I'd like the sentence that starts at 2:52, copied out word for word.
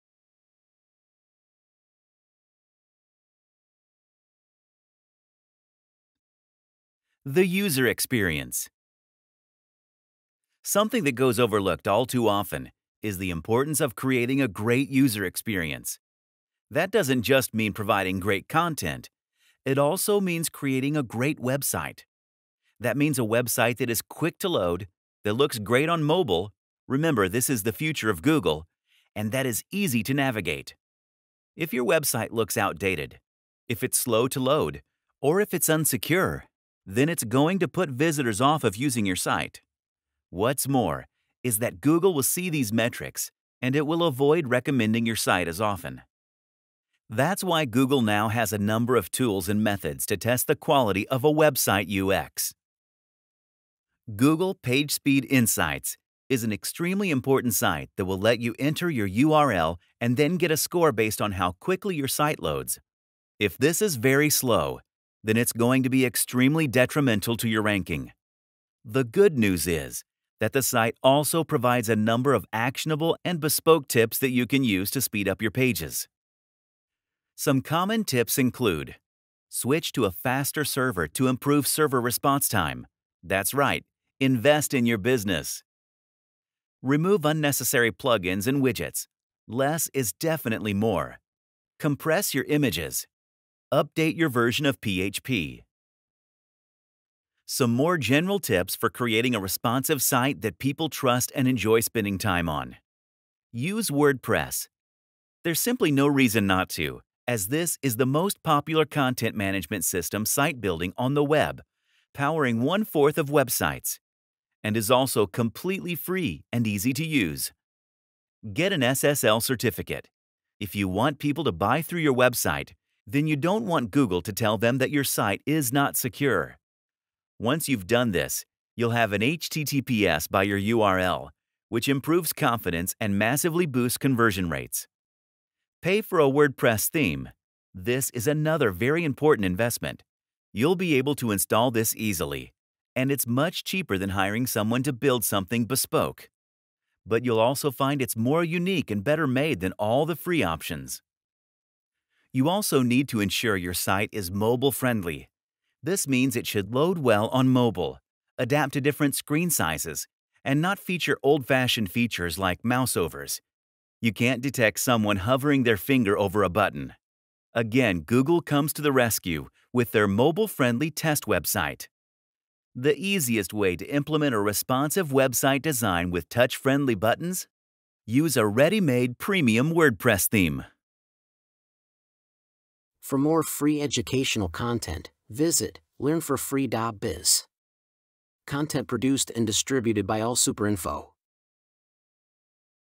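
The easiest way to implement a responsive website design with touch-friendly buttons?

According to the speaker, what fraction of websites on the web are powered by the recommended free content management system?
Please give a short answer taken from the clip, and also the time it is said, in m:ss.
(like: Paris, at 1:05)
one fourth, at 1:52.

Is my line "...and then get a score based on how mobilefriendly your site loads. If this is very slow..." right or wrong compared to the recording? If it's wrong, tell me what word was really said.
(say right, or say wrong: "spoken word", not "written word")
wrong: "quickly", not "mobilefriendly".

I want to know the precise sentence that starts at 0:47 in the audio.
That's why Google now has a number of tools and methods to test the quality of a website UX.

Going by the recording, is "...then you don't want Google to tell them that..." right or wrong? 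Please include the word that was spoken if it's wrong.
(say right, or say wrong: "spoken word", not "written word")
right.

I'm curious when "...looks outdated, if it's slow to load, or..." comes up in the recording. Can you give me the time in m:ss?
0:32.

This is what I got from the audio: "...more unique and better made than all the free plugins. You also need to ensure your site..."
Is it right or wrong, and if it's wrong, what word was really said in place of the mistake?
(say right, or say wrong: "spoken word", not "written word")
wrong: "options", not "plugins".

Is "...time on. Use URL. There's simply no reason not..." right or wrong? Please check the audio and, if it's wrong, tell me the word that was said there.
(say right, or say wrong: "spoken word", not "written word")
wrong: "WordPress", not "URL".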